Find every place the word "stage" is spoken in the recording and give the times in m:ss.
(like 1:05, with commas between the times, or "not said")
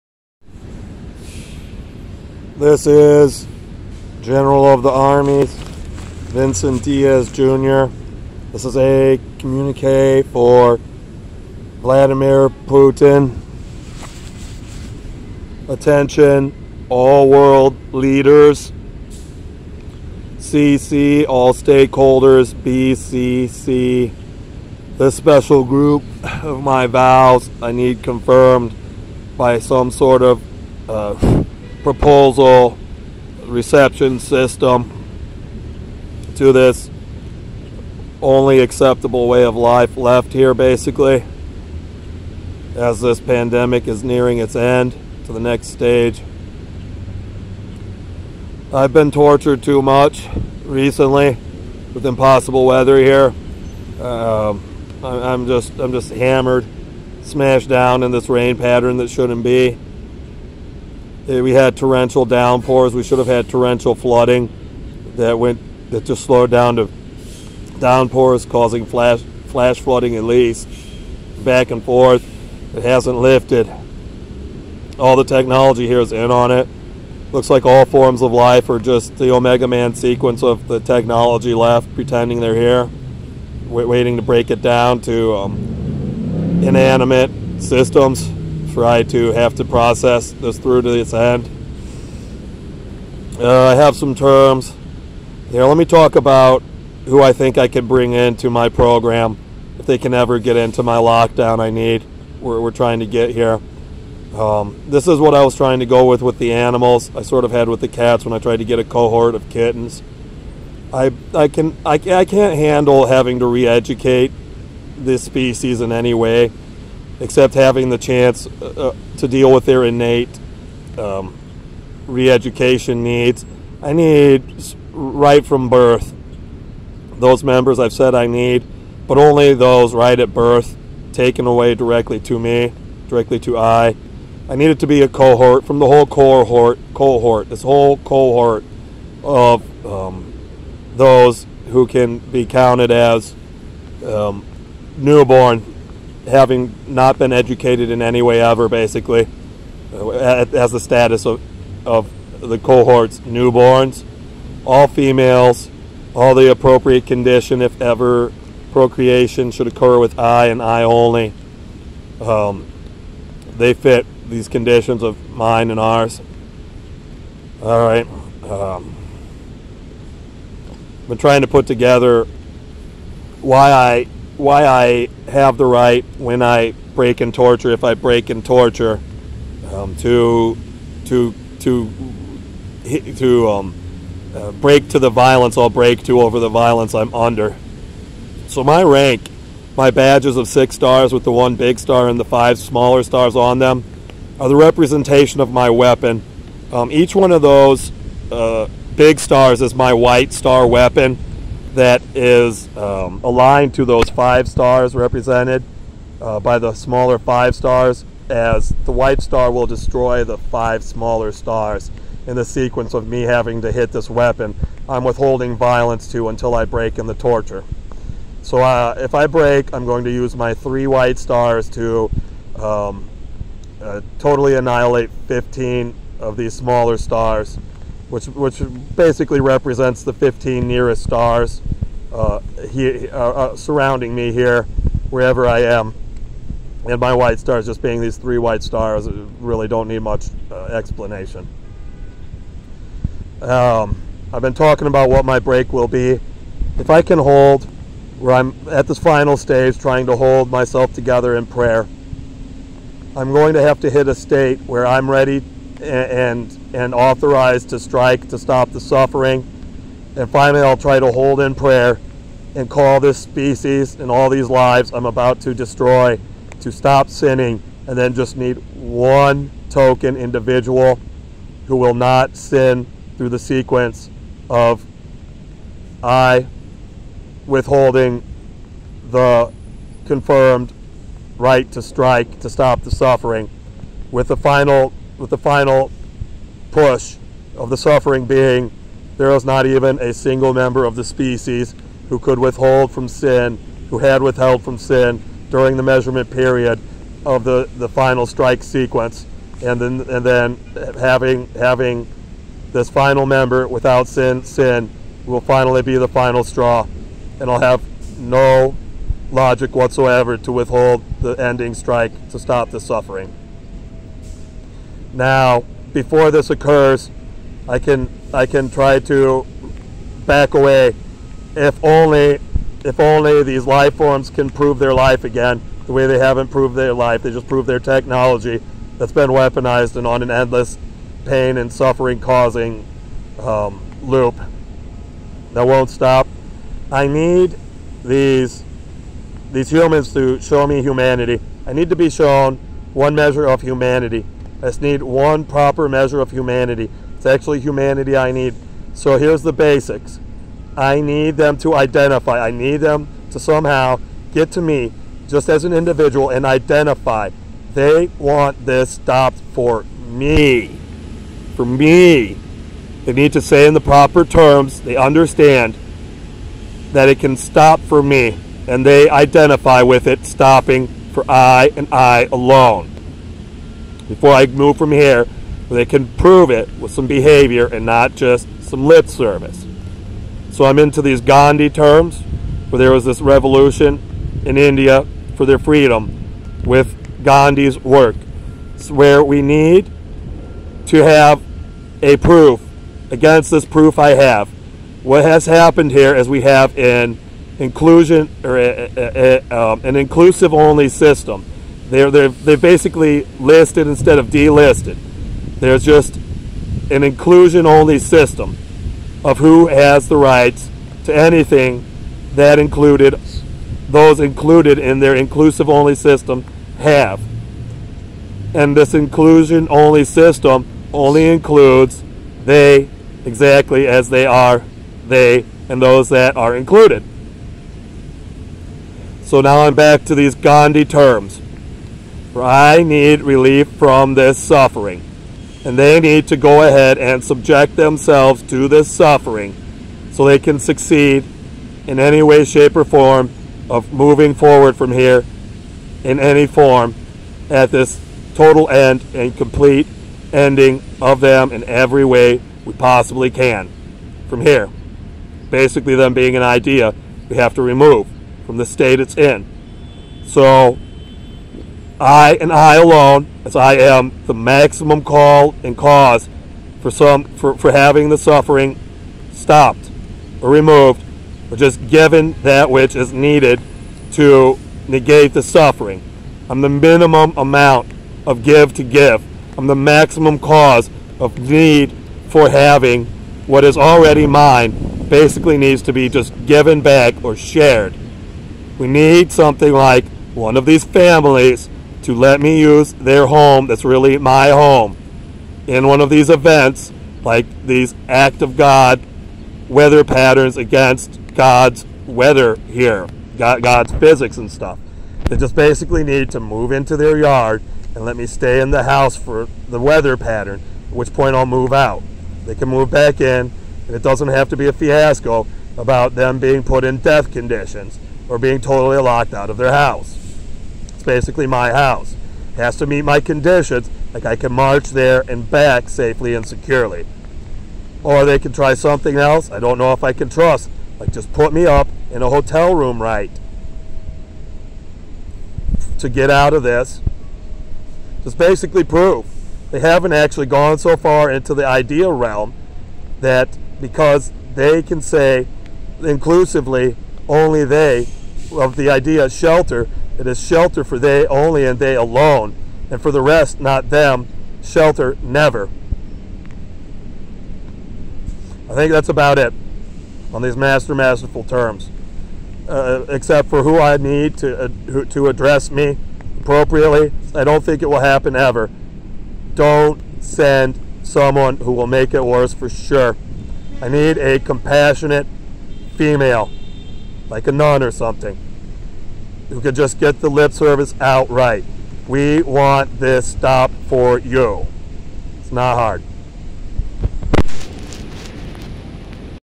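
0:45, 4:09.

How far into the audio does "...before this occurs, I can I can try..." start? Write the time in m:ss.
5:15.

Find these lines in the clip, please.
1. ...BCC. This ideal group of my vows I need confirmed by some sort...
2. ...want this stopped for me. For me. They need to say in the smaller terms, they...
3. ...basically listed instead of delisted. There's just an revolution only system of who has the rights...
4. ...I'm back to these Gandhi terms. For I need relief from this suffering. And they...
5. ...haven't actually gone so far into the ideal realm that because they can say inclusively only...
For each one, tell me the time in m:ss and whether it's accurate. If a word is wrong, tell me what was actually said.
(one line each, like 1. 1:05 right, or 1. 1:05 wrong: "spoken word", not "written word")
1. 0:22 wrong: "special", not "ideal"
2. 5:58 wrong: "proper", not "smaller"
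3. 6:42 wrong: "inclusion", not "revolution"
4. 7:09 right
5. 8:59 right.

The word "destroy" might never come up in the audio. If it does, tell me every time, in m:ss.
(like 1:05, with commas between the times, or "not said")
3:29, 4:25.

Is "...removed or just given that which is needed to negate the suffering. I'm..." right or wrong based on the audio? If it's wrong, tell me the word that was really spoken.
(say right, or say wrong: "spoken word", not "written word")
right.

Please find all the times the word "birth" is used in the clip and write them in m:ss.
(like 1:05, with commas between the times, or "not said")
2:05, 2:10.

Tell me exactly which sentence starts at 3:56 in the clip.
And my white stars just being these three white stars uh, really don't need much uh, explanation.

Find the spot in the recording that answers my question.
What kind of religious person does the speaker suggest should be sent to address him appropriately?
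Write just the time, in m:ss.
9:37.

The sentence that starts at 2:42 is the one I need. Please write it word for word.
Um, they fit these conditions of mine and ours.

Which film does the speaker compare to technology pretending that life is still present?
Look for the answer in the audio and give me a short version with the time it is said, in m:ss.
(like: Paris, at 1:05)
The Omega Man, at 1:19.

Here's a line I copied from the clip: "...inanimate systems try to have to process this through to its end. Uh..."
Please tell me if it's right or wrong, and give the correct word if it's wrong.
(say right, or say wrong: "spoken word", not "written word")
right.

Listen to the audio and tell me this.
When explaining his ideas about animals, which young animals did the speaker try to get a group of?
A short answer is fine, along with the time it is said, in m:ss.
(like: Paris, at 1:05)
Kittens, at 1:49.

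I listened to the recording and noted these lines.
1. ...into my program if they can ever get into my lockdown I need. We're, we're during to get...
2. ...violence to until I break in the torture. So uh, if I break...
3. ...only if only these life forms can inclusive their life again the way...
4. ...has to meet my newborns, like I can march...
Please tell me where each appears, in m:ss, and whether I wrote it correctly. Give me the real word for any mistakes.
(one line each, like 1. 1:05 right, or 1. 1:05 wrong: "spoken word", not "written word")
1. 1:38 wrong: "trying", not "during"
2. 3:35 right
3. 5:21 wrong: "prove", not "inclusive"
4. 8:42 wrong: "conditions", not "newborns".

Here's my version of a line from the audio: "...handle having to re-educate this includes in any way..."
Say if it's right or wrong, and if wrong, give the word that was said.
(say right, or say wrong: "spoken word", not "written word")
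wrong: "species", not "includes".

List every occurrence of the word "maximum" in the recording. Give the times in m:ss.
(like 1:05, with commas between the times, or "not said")
7:44, 7:59.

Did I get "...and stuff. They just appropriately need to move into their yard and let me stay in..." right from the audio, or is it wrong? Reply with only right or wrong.
wrong.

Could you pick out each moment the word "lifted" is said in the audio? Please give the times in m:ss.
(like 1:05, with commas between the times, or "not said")
1:13.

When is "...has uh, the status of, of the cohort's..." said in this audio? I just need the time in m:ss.
2:29.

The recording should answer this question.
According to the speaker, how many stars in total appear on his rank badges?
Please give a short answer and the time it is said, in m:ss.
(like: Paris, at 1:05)
6, at 3:10.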